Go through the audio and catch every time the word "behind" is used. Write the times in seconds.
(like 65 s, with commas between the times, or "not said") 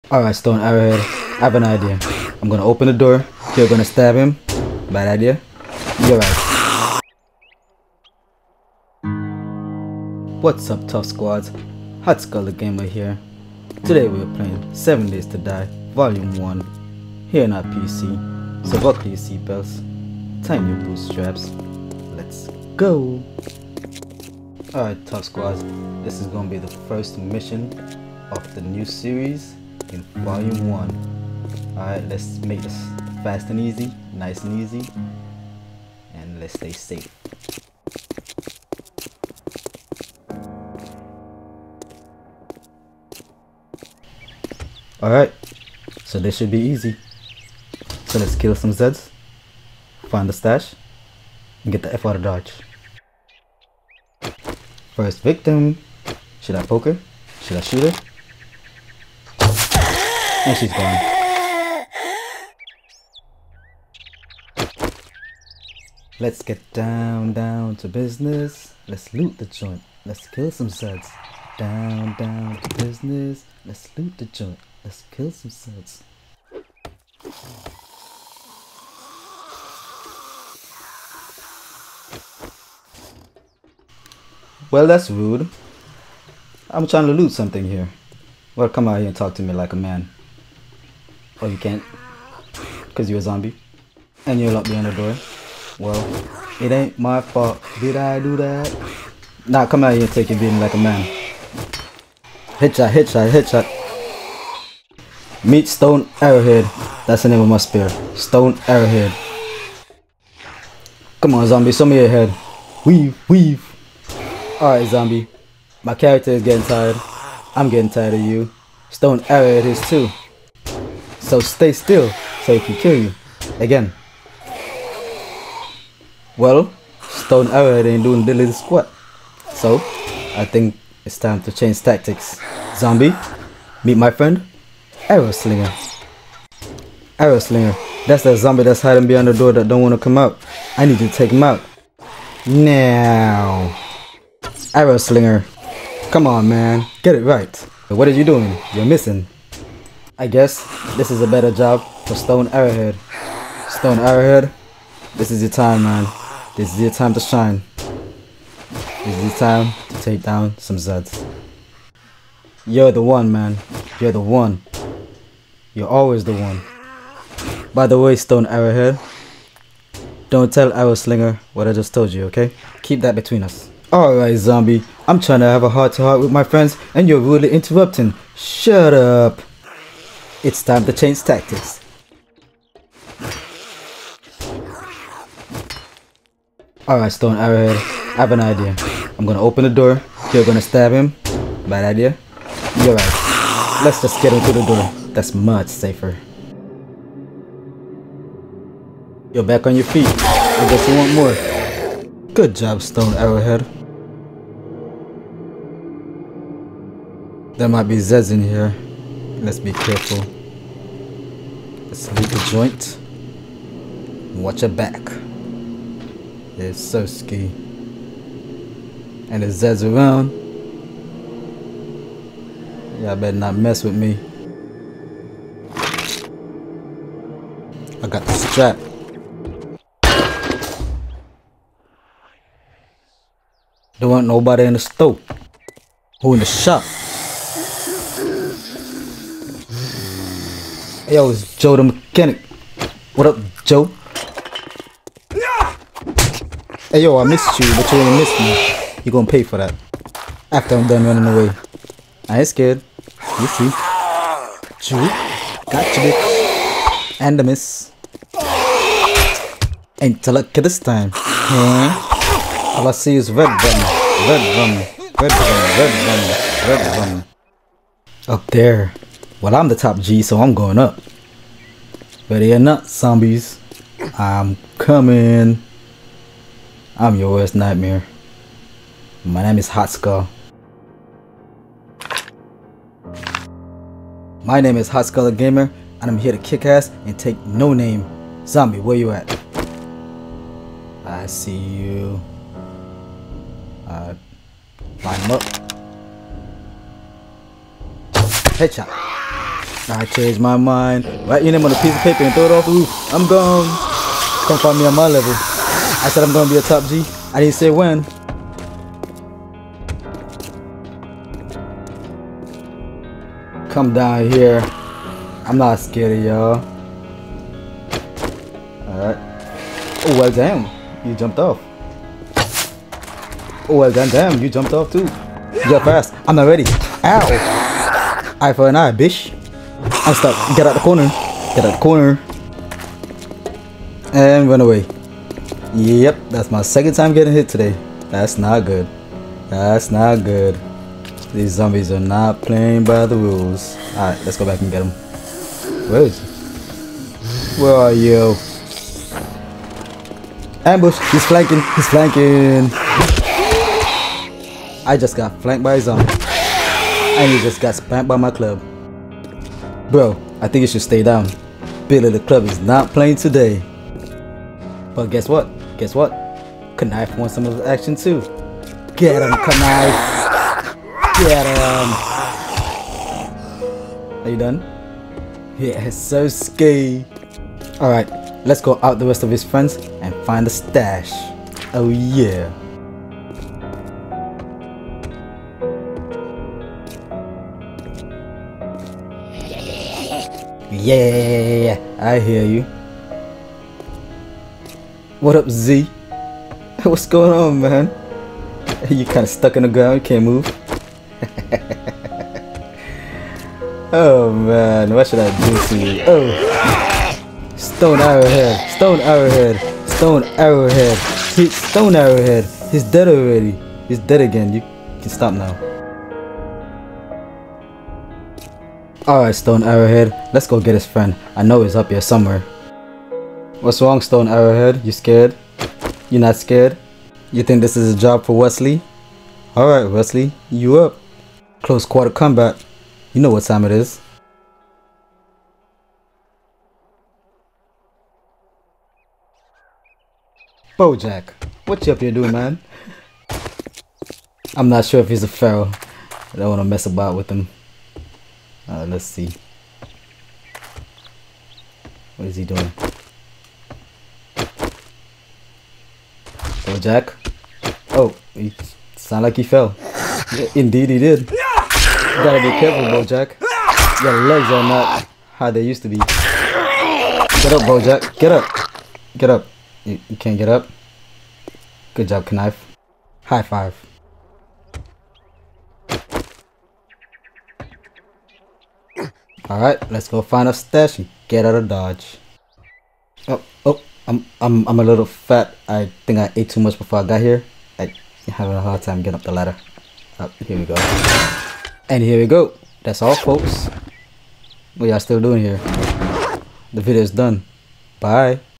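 94 s, 139 s.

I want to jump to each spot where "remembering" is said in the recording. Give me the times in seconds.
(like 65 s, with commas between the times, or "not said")
not said.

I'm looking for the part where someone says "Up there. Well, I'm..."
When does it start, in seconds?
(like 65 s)
268 s.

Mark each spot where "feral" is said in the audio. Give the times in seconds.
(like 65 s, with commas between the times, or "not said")
445 s.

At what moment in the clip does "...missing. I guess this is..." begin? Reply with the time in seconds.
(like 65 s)
148 s.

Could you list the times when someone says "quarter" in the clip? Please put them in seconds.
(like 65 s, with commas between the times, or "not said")
431 s.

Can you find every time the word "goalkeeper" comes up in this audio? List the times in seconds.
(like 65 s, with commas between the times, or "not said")
not said.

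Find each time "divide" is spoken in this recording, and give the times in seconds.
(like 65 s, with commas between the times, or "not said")
not said.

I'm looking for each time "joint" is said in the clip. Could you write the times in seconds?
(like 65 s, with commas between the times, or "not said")
69 s, 74 s, 212 s.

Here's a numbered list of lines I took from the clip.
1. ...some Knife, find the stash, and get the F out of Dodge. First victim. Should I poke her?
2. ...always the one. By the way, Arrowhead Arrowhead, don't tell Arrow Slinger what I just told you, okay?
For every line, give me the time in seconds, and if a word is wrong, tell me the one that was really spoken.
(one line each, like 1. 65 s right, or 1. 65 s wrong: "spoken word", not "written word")
1. 48 s wrong: "Zeds", not "Knife"
2. 165 s wrong: "Stone", not "Arrowhead".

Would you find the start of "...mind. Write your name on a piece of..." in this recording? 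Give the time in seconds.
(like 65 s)
300 s.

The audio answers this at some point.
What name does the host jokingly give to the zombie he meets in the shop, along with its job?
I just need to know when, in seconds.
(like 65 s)
241 s.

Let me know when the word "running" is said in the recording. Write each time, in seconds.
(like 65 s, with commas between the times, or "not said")
251 s.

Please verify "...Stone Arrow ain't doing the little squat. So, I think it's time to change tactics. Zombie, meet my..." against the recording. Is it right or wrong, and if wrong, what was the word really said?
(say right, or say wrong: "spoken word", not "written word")
right.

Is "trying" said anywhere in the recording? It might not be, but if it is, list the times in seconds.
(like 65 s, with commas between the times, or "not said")
86 s, 175 s.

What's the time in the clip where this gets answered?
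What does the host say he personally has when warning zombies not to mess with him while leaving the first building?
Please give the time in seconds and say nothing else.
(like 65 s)
228 s.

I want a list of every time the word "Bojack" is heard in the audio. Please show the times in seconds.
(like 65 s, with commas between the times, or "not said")
440 s, 462 s, 467 s.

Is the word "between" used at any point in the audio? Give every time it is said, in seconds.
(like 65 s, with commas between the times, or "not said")
173 s.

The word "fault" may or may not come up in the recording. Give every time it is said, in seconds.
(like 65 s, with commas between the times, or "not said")
97 s.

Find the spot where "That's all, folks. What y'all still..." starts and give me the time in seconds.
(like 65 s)
492 s.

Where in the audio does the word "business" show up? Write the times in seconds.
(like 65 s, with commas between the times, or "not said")
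67 s, 72 s.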